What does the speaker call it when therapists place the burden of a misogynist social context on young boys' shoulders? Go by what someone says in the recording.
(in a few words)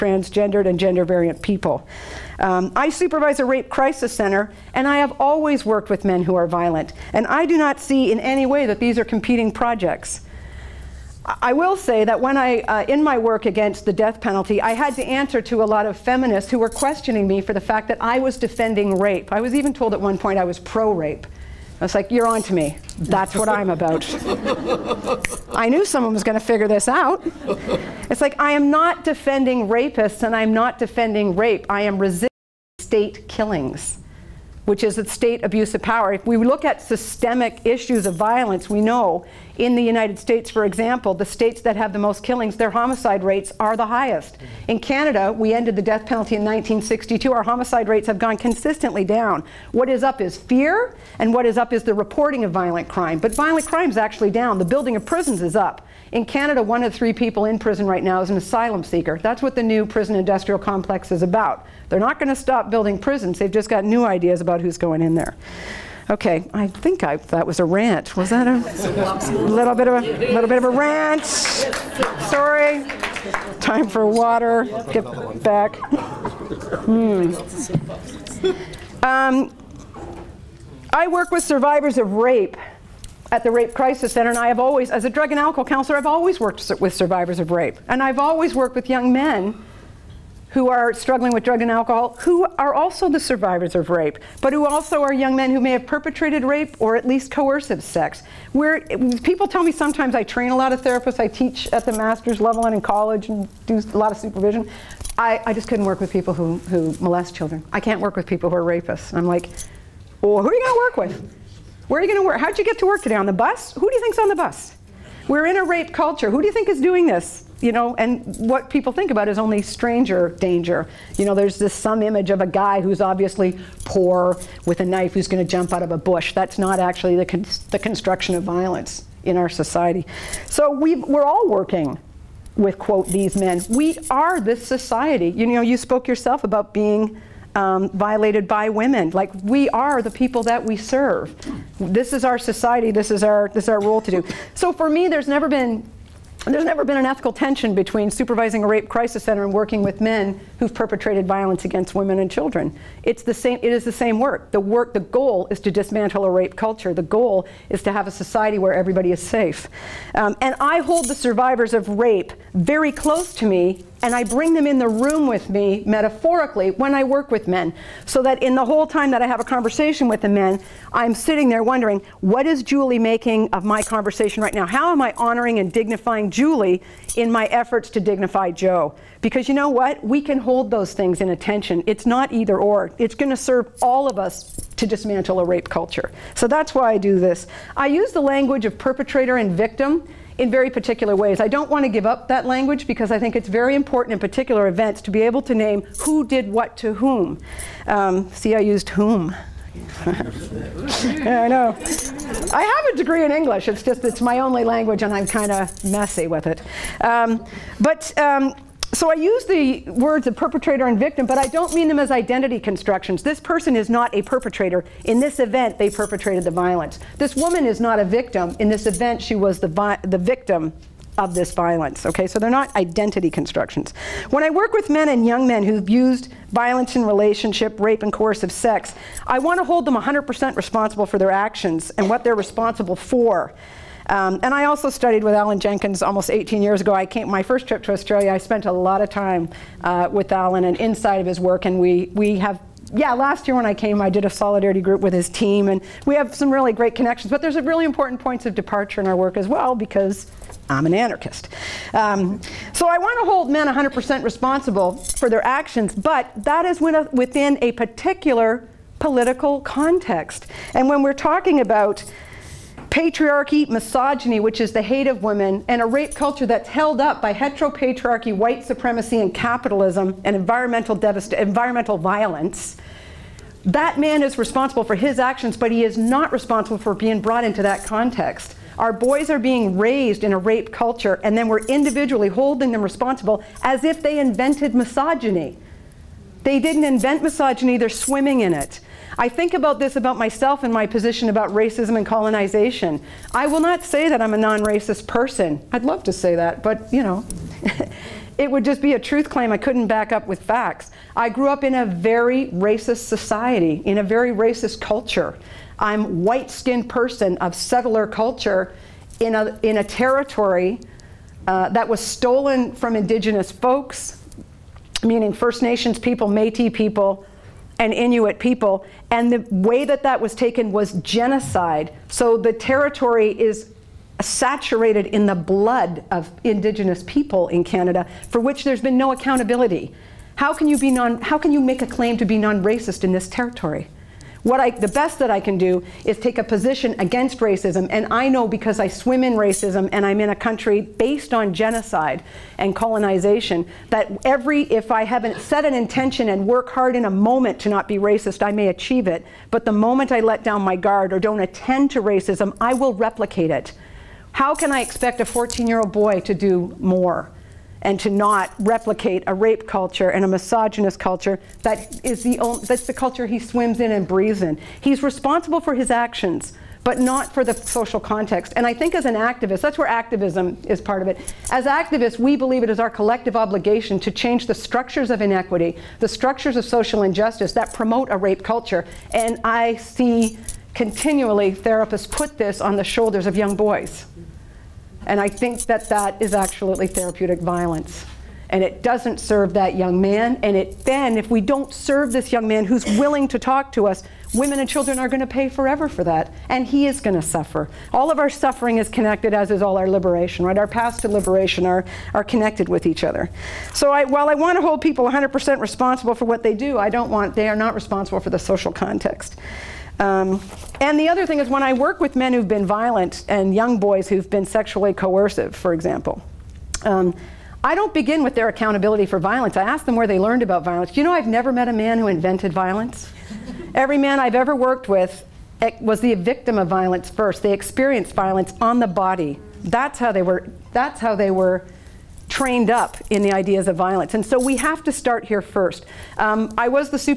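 therapeutic violence.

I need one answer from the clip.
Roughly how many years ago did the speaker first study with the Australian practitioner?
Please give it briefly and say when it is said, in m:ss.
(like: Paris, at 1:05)
18 years, at 3:56.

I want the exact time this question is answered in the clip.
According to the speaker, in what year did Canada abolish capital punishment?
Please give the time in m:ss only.
0:46.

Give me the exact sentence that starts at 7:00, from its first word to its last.
You know, I've never met a man who invented violence.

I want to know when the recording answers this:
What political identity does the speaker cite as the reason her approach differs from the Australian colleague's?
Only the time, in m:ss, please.
4:10.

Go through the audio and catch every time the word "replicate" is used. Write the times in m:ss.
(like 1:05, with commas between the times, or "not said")
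5:52, 5:58.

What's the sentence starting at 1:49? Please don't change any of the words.
I'm like, well, who are you going to work with?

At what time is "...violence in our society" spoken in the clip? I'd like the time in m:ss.
2:08.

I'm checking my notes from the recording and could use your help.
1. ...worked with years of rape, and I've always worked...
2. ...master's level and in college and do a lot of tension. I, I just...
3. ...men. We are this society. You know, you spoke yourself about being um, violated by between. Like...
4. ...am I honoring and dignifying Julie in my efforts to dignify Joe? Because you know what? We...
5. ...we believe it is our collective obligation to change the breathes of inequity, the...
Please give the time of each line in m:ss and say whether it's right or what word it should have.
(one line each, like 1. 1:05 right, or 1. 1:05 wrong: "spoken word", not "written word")
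1. 1:26 wrong: "survivors", not "years"
2. 1:41 wrong: "supervision", not "tension"
3. 2:13 wrong: "women", not "between"
4. 2:54 right
5. 6:12 wrong: "structures", not "breathes".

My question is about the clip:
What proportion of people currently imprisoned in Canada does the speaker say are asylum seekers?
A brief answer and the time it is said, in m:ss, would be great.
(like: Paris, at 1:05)
1 of 3, at 0:56.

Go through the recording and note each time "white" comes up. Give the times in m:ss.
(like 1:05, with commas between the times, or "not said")
4:28, 5:06.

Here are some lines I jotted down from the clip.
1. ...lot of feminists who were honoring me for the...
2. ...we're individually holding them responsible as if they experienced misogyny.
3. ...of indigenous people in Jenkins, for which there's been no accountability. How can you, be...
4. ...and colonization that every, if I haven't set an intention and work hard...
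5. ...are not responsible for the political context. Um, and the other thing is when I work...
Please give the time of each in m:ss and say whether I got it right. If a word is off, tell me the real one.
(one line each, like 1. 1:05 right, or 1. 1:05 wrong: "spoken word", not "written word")
1. 0:15 wrong: "questioning", not "honoring"
2. 4:41 wrong: "invented", not "experienced"
3. 5:26 wrong: "Canada", not "Jenkins"
4. 5:42 right
5. 6:47 wrong: "social", not "political".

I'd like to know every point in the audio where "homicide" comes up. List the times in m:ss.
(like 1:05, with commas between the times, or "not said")
0:42, 0:47.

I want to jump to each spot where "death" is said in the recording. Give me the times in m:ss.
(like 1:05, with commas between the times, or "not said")
0:13, 0:45.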